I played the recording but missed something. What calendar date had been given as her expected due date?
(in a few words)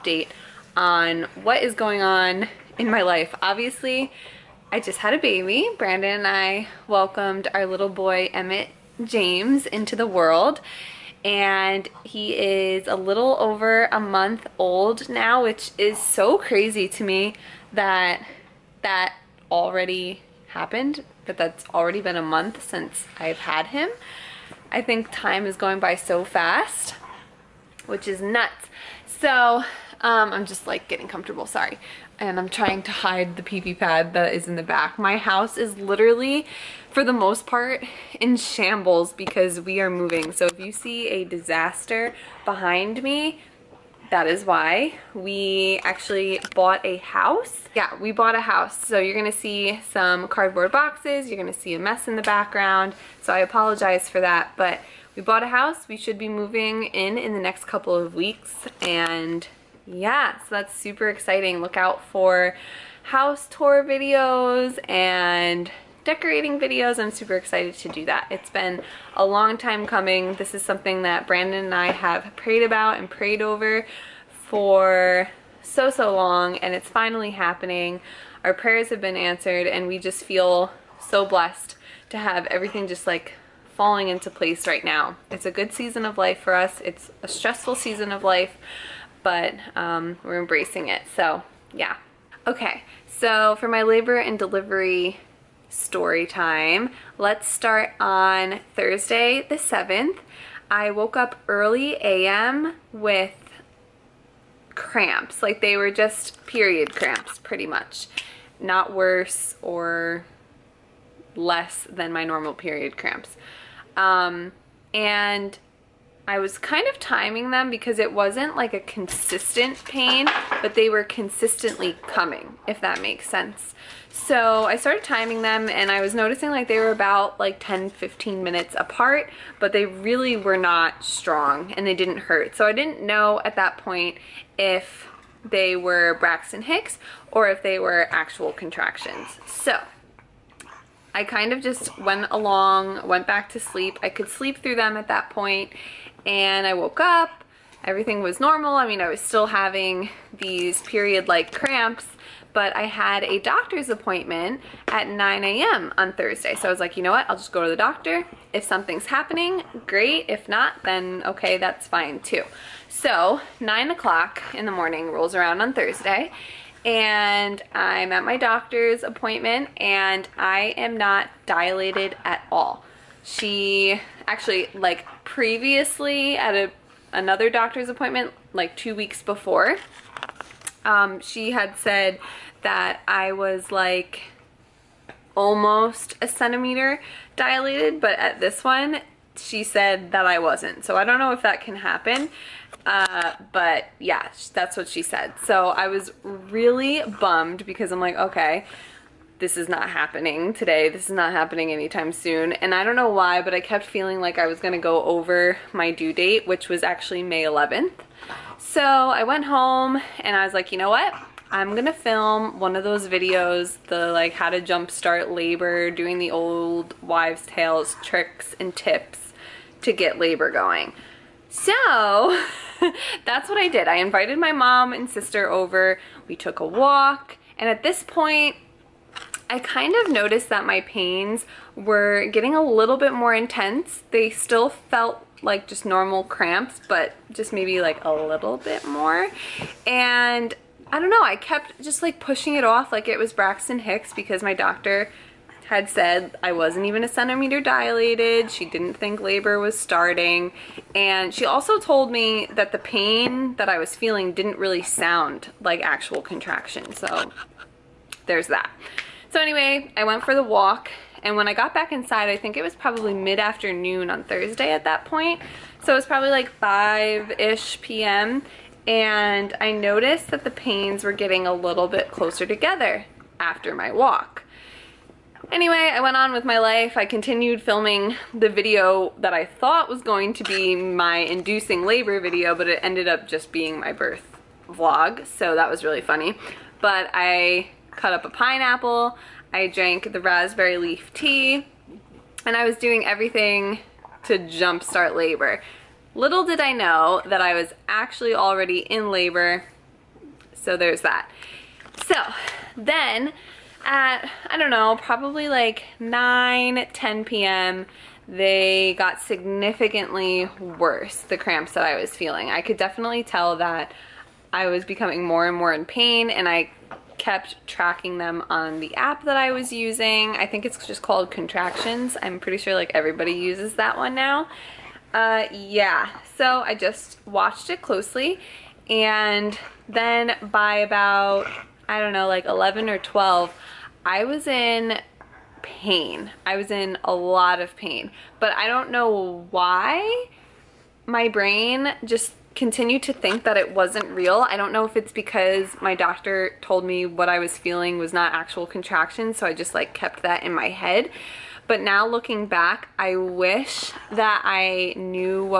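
May 11th.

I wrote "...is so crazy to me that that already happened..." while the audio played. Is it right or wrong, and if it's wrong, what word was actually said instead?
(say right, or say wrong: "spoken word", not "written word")
right.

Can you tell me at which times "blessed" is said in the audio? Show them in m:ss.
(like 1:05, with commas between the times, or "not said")
1:21.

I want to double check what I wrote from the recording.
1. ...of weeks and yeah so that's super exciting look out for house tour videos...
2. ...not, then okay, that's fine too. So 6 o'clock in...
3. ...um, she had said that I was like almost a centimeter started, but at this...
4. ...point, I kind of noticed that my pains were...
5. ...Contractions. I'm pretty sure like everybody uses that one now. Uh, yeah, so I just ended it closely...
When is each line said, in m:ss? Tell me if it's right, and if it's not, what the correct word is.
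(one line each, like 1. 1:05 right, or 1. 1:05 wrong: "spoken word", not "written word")
1. 0:57 right
2. 2:40 wrong: "9", not "6"
3. 3:00 wrong: "dilated", not "started"
4. 3:48 right
5. 5:21 wrong: "watched", not "ended".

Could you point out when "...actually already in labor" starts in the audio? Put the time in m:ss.
4:57.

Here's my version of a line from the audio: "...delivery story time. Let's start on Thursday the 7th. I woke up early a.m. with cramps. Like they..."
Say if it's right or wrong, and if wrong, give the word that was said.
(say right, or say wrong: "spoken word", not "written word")
right.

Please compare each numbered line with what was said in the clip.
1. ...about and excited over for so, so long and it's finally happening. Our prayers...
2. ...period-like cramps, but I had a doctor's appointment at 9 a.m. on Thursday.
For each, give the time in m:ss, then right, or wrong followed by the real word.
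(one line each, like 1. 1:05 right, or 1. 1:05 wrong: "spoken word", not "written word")
1. 1:12 wrong: "prayed", not "excited"
2. 2:30 right.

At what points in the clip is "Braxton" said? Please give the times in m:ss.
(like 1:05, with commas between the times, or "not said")
2:16, 4:03.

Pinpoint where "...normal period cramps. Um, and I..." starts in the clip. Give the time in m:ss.
1:52.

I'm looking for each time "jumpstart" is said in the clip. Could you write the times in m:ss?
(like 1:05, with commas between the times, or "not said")
3:34, 4:54.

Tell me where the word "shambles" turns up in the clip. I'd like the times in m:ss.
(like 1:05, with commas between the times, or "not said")
0:38.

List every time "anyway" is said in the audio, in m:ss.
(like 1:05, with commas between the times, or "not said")
4:19, 4:35.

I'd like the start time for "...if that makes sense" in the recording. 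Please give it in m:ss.
2:02.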